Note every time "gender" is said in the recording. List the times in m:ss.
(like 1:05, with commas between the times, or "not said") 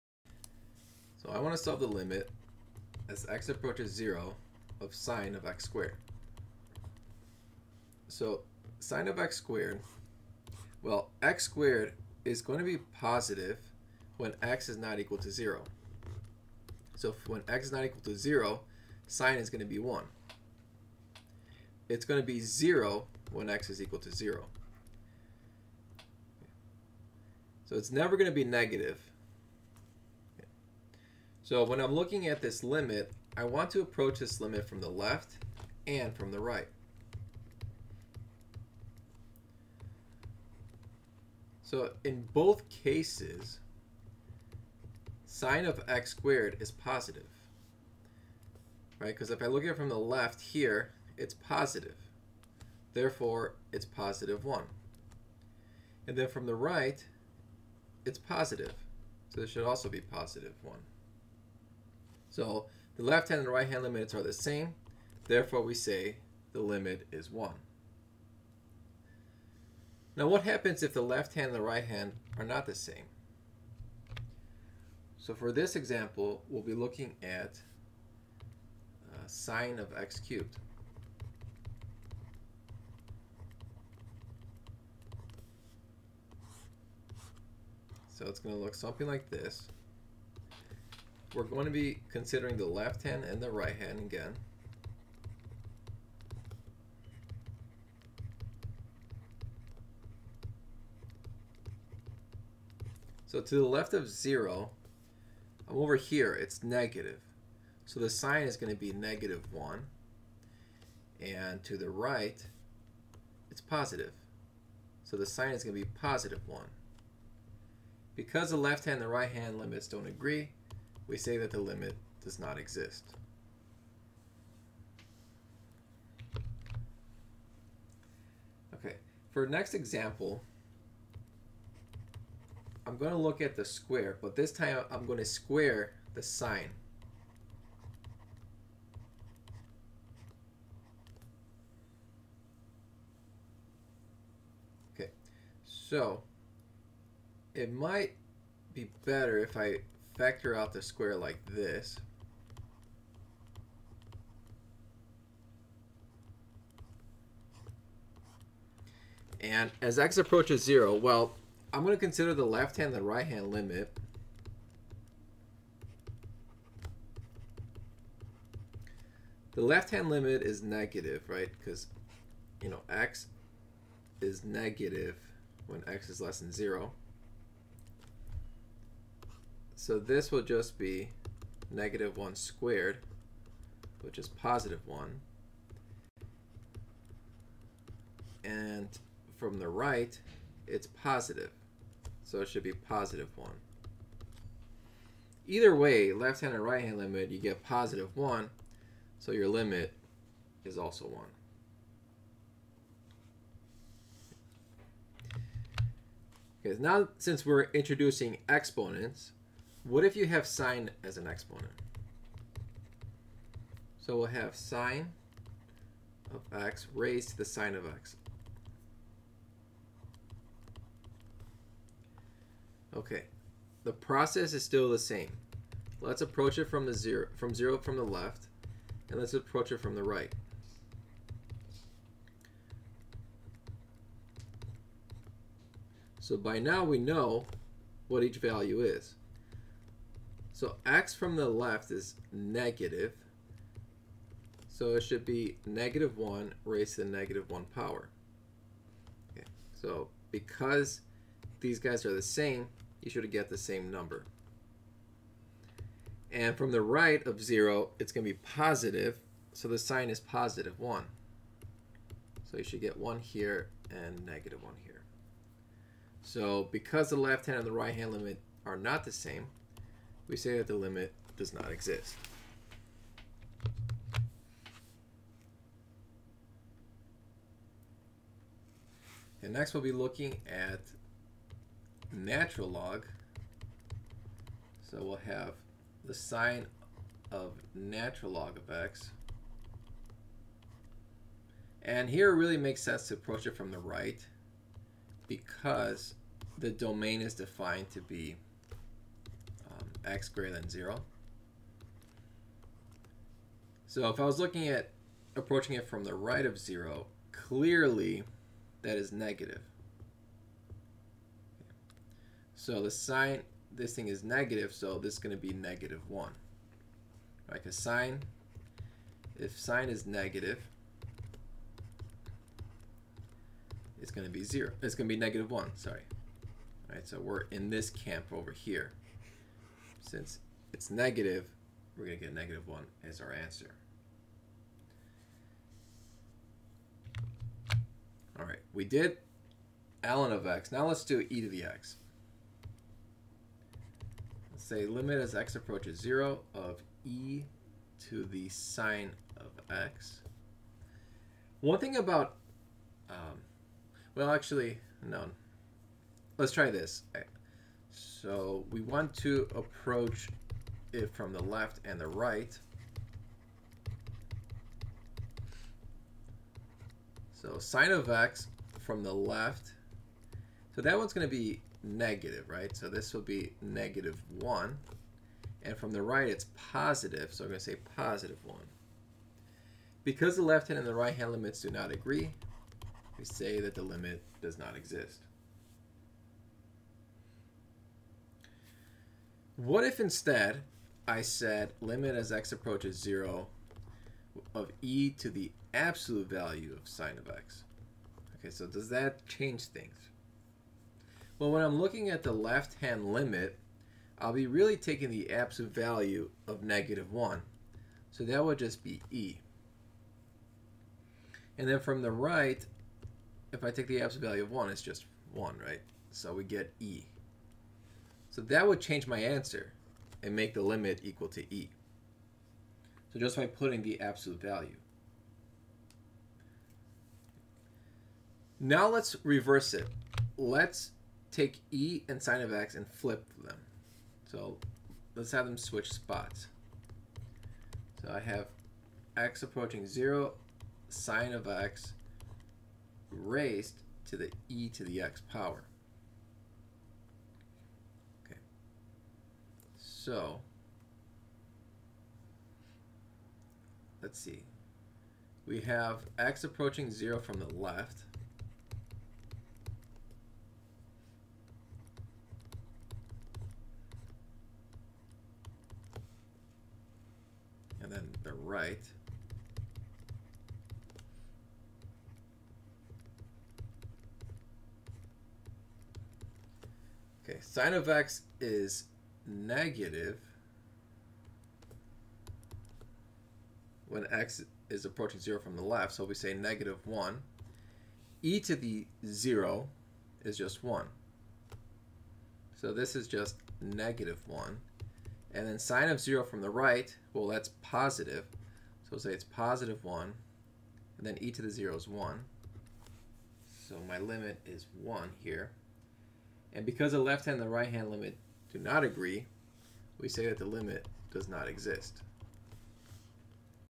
not said.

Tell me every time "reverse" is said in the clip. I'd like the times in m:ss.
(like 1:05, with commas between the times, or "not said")
7:09.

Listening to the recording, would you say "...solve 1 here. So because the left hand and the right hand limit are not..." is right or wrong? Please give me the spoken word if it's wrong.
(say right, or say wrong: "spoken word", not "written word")
wrong: "negative", not "solve".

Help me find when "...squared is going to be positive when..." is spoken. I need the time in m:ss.
0:11.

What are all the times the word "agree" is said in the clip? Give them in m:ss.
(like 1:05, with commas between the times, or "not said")
2:00, 6:21, 8:28.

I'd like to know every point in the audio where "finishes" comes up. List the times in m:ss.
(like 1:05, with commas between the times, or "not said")
not said.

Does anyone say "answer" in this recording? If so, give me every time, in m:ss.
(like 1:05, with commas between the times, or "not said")
5:33, 6:59.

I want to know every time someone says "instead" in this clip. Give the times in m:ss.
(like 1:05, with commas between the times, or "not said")
6:29.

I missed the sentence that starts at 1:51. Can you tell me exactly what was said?
And to the right, it's positive.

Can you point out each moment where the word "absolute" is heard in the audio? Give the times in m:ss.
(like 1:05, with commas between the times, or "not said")
6:35, 6:45, 6:54, 7:03.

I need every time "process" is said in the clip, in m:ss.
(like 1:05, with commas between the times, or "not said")
3:43.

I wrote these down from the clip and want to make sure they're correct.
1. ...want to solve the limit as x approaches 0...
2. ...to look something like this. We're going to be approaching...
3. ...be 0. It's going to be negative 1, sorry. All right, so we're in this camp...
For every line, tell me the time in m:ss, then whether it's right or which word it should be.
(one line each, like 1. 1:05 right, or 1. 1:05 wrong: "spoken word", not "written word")
1. 0:01 right
2. 1:28 wrong: "considering", not "approaching"
3. 5:24 right.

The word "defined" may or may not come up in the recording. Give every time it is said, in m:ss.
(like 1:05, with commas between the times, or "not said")
4:57.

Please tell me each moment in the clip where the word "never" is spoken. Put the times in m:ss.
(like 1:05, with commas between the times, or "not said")
0:27.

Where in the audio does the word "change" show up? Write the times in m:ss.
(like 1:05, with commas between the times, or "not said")
6:39, 6:58.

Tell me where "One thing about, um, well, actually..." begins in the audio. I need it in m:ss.
5:51.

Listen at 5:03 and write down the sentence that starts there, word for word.
So if I was looking at approaching it from the right of 0, clearly that is negative.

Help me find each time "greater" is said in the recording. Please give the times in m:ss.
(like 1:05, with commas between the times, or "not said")
5:00.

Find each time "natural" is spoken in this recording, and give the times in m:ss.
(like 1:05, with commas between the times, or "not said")
4:42, 4:47.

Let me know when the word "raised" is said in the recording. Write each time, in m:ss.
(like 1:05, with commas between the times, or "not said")
3:36, 4:06, 7:23.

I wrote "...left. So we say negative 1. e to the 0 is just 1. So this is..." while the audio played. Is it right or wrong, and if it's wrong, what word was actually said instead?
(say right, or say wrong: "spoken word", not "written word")
right.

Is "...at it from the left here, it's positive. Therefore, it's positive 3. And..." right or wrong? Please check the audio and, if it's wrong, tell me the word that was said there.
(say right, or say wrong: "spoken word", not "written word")
wrong: "1", not "3".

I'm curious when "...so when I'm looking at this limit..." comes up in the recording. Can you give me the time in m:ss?
0:31.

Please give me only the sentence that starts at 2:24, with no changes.
Okay, so it might be better if I factor out the square like this.